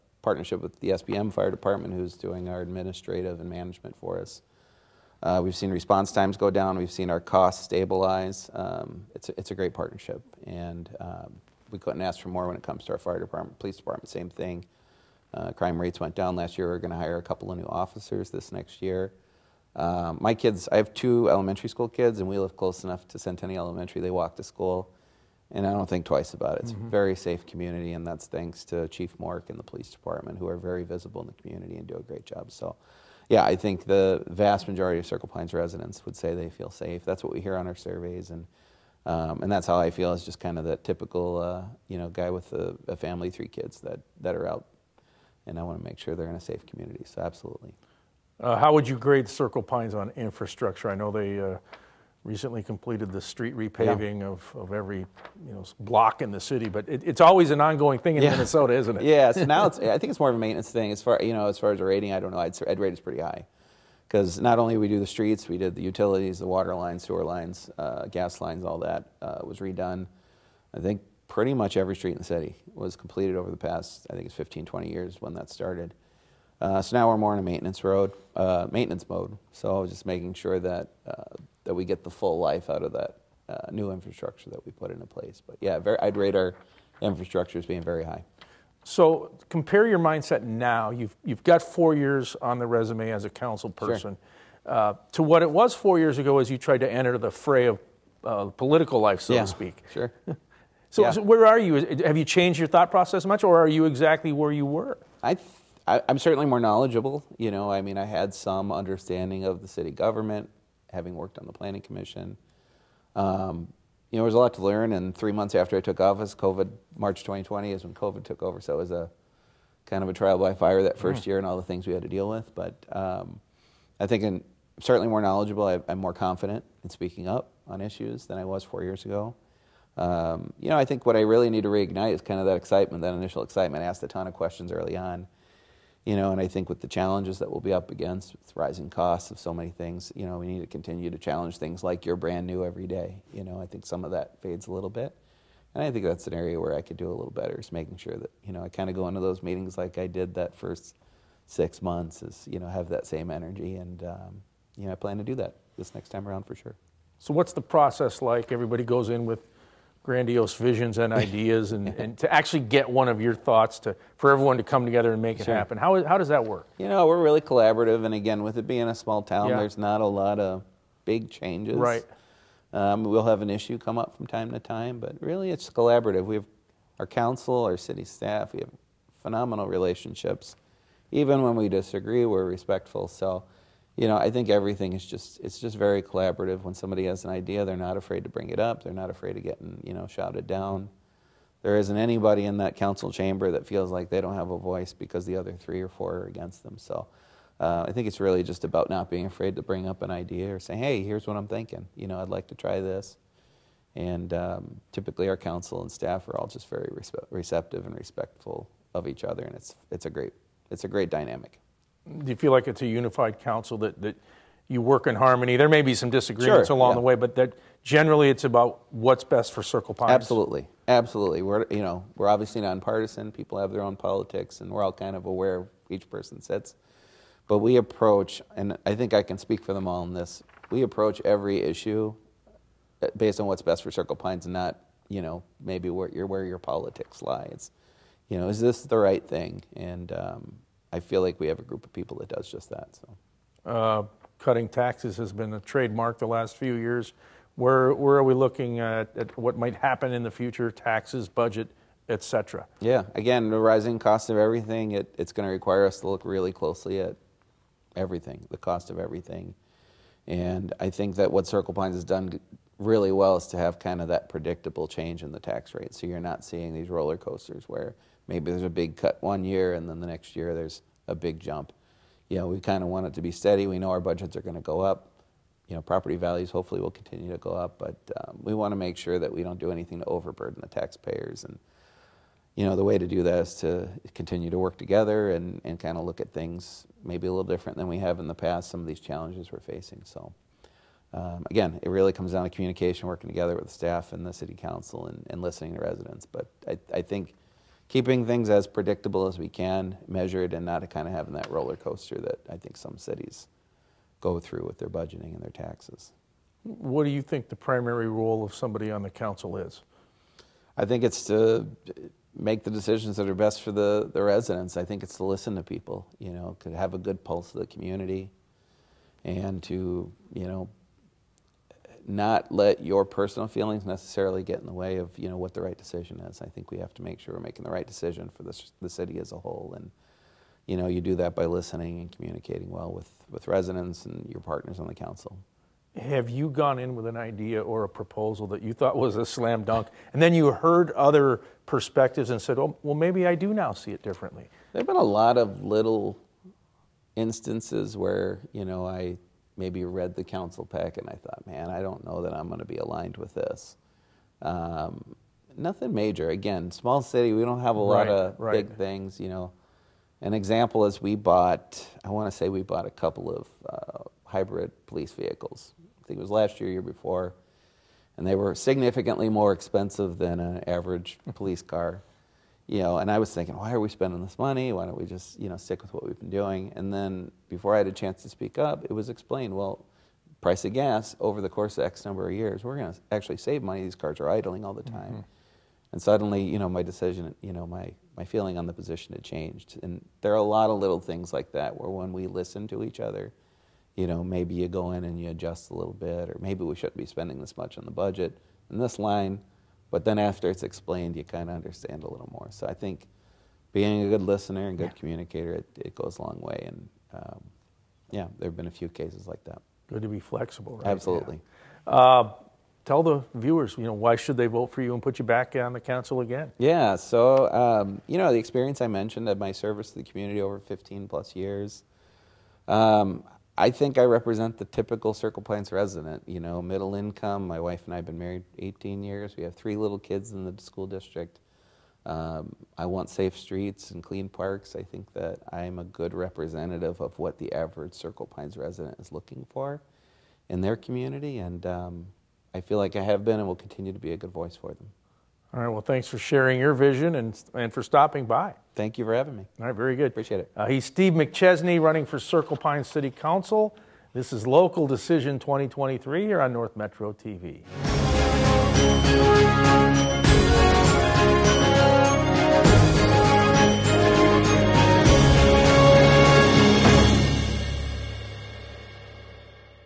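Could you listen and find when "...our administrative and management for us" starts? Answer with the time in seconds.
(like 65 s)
2 s.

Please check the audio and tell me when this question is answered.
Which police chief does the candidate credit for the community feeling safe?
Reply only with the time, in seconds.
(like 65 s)
28 s.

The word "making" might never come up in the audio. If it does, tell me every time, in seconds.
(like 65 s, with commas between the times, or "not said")
80 s, 147 s, 327 s.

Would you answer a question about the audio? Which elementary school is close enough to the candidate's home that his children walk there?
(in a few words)
Centennial Elementary.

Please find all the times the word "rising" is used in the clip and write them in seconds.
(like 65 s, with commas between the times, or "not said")
138 s, 253 s.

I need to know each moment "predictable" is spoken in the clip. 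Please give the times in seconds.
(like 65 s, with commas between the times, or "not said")
264 s, 298 s.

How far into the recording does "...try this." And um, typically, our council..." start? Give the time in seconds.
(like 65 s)
202 s.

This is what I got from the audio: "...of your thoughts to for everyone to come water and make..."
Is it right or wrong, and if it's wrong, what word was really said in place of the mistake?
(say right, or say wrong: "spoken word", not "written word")
wrong: "together", not "water".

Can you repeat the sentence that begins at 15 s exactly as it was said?
Uh, crime rates went down last year.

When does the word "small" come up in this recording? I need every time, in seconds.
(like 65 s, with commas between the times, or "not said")
168 s, 356 s.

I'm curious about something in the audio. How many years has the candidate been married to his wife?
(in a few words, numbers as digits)
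18.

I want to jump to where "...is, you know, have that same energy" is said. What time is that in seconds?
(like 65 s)
152 s.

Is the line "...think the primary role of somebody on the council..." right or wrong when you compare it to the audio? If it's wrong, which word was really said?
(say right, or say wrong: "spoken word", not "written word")
right.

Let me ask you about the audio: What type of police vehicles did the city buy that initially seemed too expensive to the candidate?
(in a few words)
hybrid.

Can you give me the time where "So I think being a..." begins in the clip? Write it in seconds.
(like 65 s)
402 s.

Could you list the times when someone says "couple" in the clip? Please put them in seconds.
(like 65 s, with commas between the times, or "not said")
17 s, 362 s.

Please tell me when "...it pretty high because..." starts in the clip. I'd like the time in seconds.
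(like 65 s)
62 s.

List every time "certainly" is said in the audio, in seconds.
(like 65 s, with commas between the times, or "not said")
106 s, 124 s.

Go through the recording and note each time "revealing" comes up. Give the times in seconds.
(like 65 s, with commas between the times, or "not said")
not said.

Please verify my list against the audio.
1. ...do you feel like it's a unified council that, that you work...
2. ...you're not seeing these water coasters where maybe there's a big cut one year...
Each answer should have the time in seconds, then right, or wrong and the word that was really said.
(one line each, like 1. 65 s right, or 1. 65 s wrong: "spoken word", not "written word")
1. 212 s right
2. 266 s wrong: "roller", not "water".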